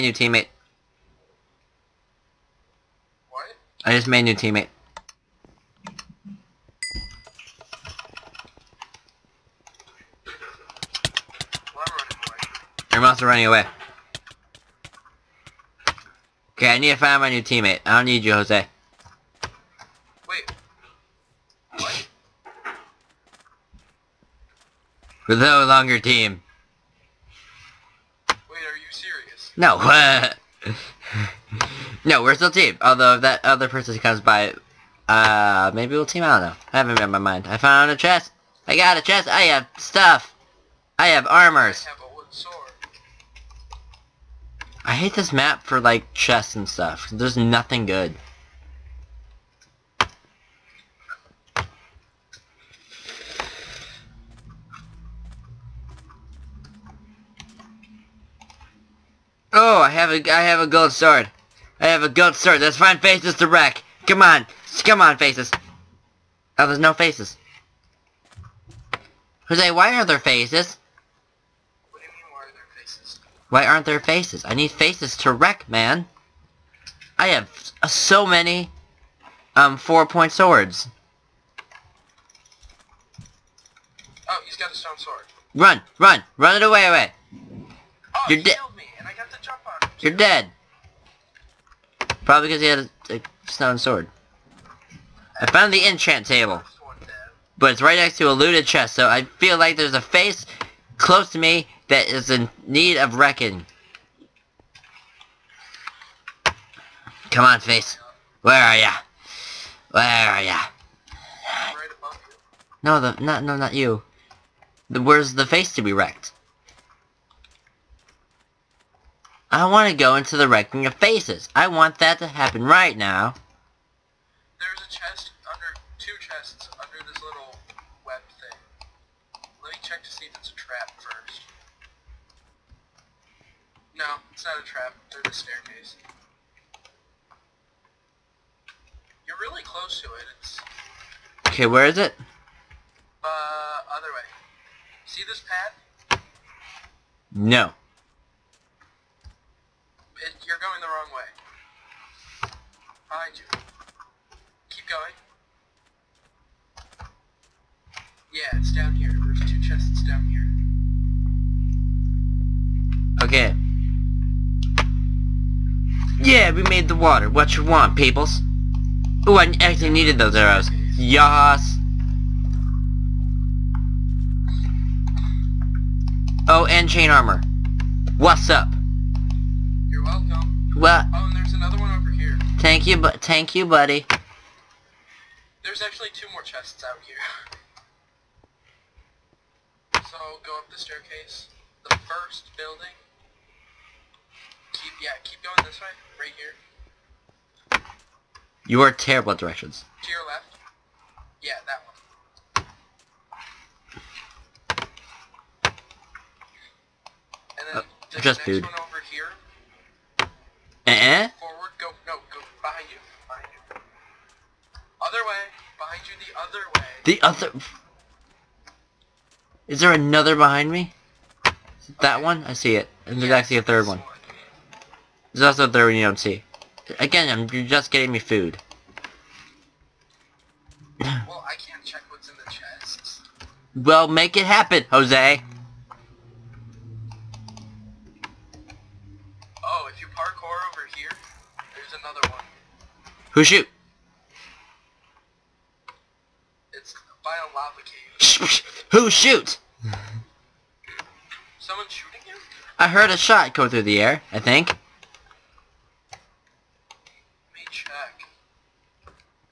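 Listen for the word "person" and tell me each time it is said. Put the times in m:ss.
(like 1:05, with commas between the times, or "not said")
0:33.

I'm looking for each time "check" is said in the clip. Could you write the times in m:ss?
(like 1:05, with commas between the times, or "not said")
2:09, 3:51.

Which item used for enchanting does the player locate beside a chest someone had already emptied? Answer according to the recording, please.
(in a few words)
Enchant table.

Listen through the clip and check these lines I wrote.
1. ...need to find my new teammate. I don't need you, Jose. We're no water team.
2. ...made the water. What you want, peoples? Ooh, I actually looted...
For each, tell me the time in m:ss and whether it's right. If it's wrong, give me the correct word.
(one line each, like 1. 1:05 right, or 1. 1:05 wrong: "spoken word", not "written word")
1. 0:16 wrong: "longer", not "water"
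2. 2:46 wrong: "needed", not "looted".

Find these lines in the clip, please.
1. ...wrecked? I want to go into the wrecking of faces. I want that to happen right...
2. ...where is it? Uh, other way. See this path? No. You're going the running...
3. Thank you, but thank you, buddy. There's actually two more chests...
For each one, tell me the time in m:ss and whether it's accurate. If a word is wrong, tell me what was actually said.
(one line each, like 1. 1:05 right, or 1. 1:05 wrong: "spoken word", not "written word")
1. 1:55 right
2. 2:21 wrong: "wrong", not "running"
3. 3:02 right.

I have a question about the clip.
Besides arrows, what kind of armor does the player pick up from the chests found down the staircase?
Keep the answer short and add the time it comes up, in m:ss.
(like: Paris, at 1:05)
Chain armor, at 2:56.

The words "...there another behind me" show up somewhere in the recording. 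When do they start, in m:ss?
3:39.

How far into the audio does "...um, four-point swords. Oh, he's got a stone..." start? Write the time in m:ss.
1:19.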